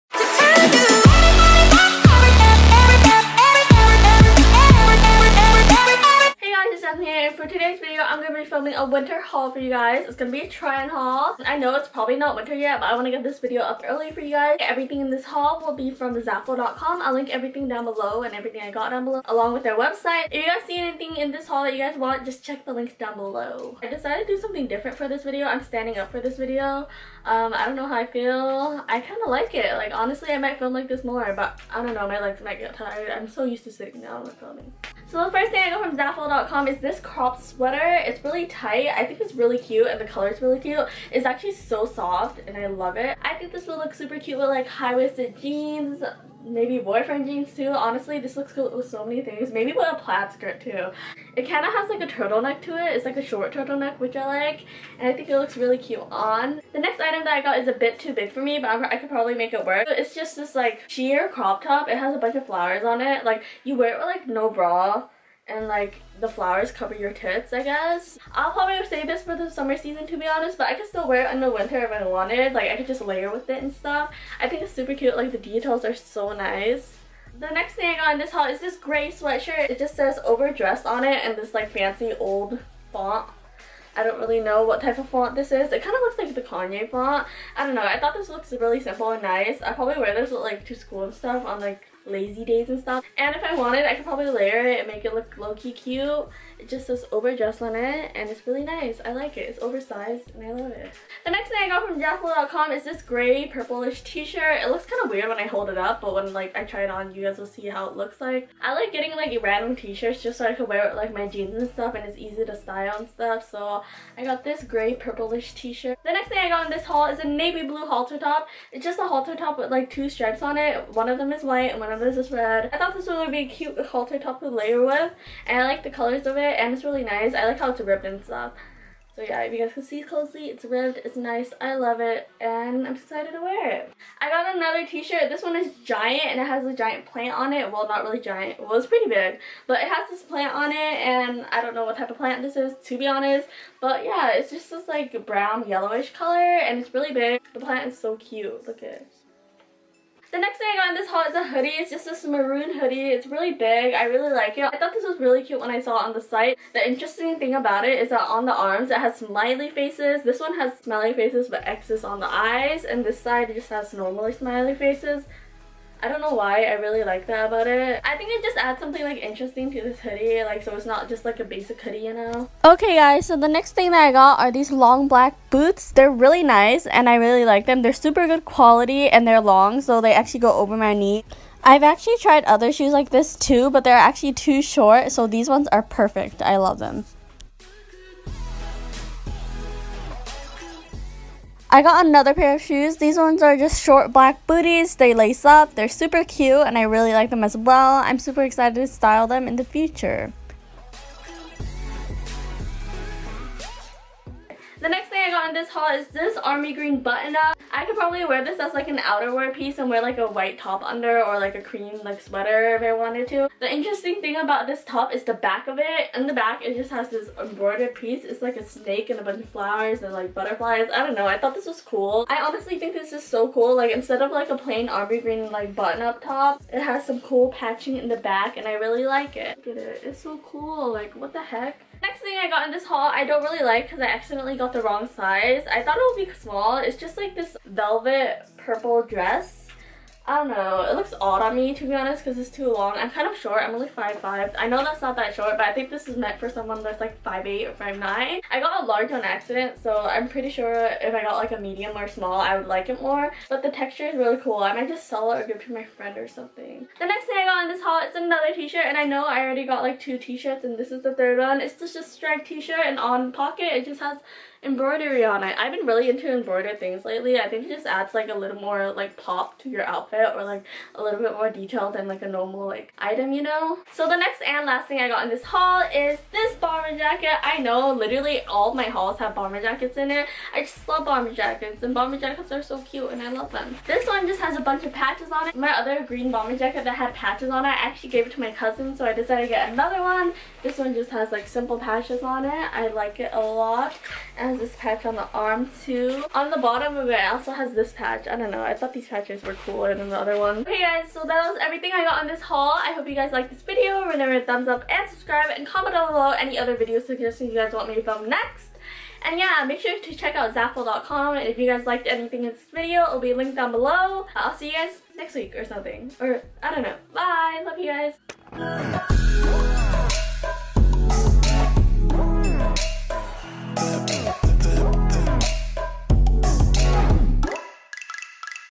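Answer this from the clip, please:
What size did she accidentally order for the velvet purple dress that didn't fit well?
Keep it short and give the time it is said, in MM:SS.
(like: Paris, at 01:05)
large, at 04:08.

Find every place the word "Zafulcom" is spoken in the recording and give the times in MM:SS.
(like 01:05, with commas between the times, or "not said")
00:16, 00:35, 01:41, 05:10.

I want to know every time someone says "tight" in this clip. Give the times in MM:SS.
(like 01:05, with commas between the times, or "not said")
00:38.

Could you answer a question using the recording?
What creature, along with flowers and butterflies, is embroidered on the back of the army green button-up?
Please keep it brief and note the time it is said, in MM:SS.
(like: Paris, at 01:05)
snake, at 03:38.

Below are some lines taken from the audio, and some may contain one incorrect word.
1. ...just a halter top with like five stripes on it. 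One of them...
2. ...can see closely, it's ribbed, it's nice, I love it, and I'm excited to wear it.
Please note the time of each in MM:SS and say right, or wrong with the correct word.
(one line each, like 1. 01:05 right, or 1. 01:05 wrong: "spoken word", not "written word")
1. 01:58 wrong: "two", not "five"
2. 02:09 right.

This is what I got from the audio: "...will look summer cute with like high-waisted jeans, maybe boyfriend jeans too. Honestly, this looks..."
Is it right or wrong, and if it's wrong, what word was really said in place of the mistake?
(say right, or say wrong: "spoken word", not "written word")
wrong: "super", not "summer".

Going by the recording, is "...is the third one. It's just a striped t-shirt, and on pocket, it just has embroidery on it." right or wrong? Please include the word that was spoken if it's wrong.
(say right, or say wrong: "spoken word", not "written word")
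right.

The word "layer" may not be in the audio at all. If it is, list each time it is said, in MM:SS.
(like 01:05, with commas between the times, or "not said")
01:13, 01:34, 02:04.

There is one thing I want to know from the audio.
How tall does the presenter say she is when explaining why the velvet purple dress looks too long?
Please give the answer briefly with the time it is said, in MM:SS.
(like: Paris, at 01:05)
5'5", at 04:03.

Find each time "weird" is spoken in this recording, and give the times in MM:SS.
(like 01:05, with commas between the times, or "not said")
01:45.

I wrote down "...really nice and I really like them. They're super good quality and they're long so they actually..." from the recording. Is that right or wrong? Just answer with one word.
right.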